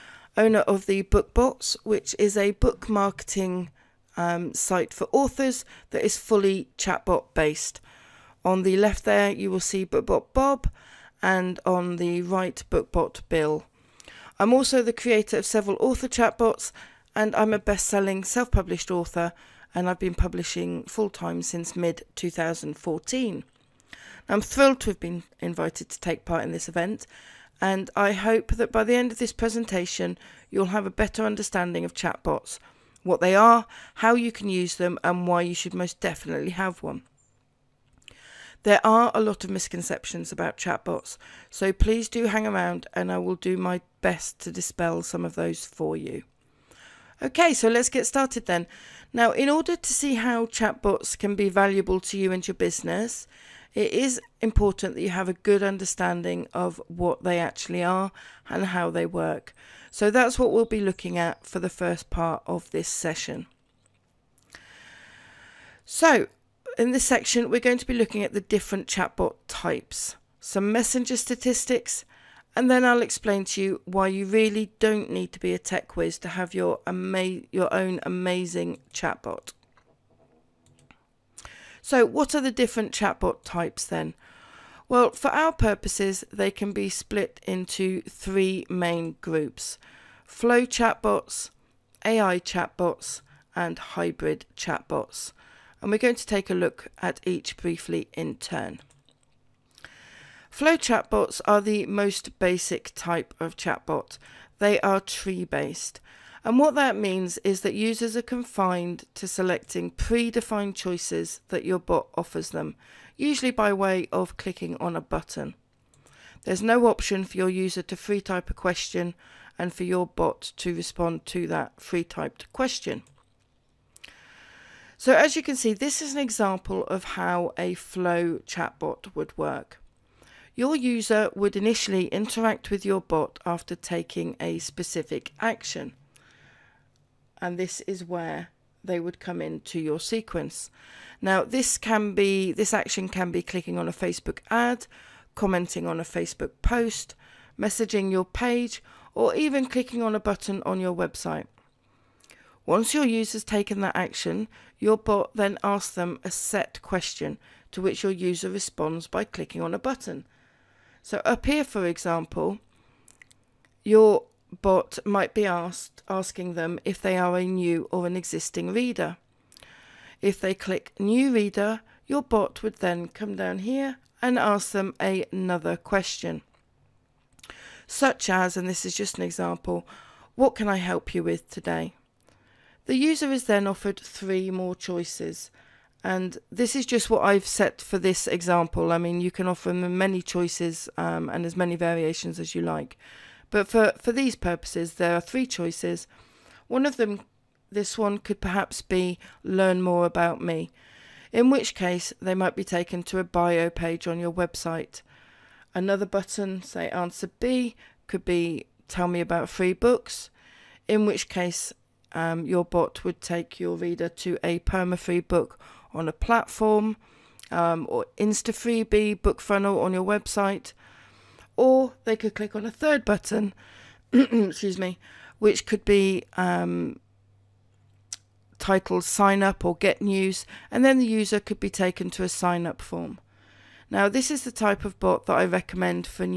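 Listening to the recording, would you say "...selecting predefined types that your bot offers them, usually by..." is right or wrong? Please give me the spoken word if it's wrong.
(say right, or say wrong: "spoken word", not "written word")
wrong: "choices", not "types".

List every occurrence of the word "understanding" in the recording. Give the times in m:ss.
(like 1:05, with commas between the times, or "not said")
0:31, 0:55.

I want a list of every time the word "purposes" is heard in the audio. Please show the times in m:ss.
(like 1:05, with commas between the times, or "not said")
1:25, 3:14.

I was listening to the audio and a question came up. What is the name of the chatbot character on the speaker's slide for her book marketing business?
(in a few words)
BookBot Bob.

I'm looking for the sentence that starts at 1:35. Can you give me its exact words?
And we're going to take a look at each briefly in turn.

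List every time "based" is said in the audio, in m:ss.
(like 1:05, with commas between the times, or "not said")
0:07, 1:45.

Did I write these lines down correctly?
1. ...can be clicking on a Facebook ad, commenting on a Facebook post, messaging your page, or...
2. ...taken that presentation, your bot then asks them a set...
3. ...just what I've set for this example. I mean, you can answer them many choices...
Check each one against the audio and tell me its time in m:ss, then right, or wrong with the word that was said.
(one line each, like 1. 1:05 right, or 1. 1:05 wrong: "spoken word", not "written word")
1. 2:23 right
2. 2:33 wrong: "action", not "presentation"
3. 3:06 wrong: "offer", not "answer".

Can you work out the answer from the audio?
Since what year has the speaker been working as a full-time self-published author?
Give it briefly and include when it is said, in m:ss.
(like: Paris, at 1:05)
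2014, at 0:22.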